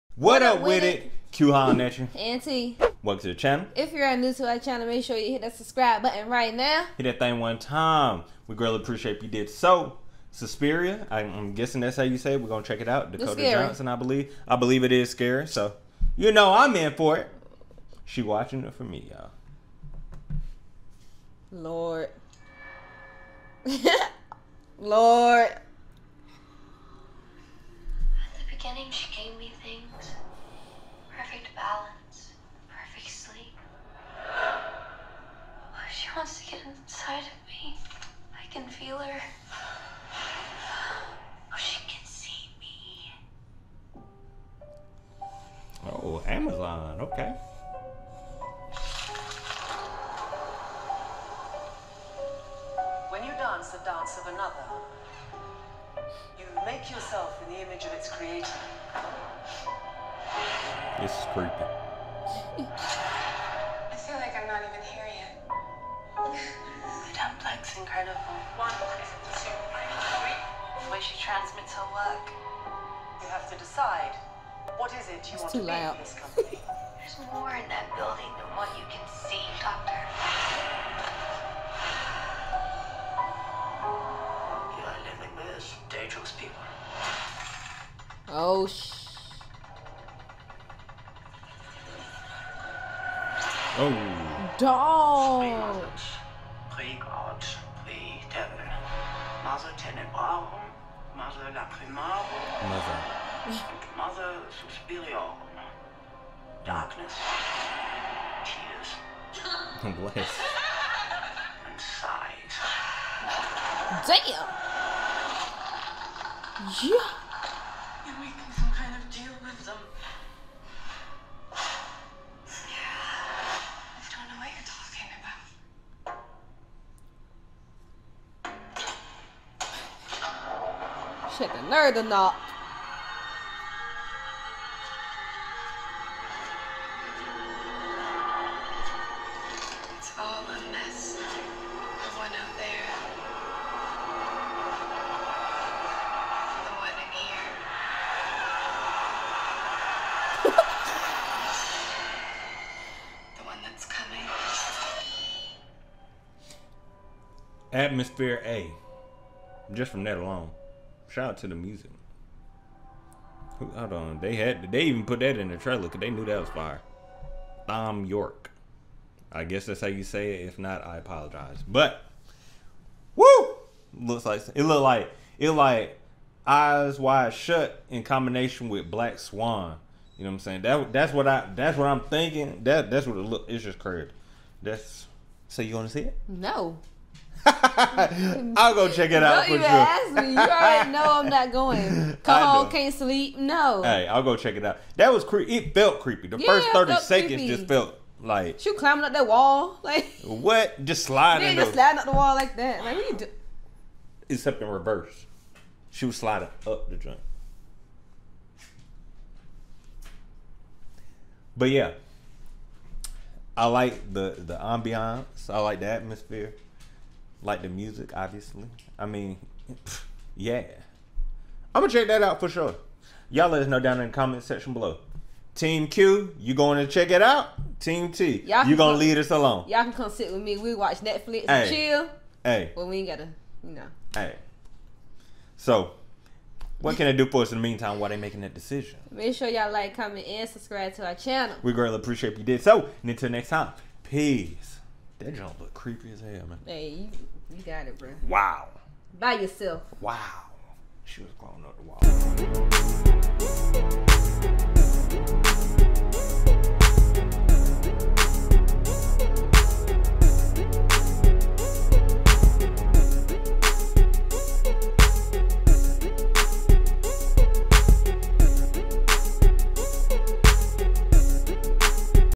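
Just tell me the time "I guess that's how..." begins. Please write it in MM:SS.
02:49.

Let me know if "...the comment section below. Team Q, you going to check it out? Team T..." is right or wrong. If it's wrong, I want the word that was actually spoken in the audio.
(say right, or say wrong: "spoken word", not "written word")
right.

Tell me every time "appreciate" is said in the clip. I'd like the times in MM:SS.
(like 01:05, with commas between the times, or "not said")
00:08, 04:01.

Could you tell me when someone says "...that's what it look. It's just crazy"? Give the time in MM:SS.
03:02.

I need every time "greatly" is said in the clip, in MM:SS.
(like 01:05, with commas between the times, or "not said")
00:08, 04:01.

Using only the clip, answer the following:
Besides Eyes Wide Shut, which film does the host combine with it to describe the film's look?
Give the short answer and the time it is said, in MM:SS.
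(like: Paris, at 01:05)
Black Swan, at 02:58.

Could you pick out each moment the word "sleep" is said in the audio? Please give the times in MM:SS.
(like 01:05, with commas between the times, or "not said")
00:33, 03:12.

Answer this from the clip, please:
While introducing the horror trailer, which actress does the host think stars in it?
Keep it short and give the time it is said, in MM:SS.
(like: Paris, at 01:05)
Dakota Johnson, at 00:13.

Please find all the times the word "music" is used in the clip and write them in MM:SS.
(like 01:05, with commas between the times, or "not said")
02:41, 03:37.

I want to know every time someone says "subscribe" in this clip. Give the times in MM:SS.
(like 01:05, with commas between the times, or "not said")
00:05, 04:00.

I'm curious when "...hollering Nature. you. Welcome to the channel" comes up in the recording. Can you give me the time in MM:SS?
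00:01.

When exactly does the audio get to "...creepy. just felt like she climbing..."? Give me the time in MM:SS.
03:17.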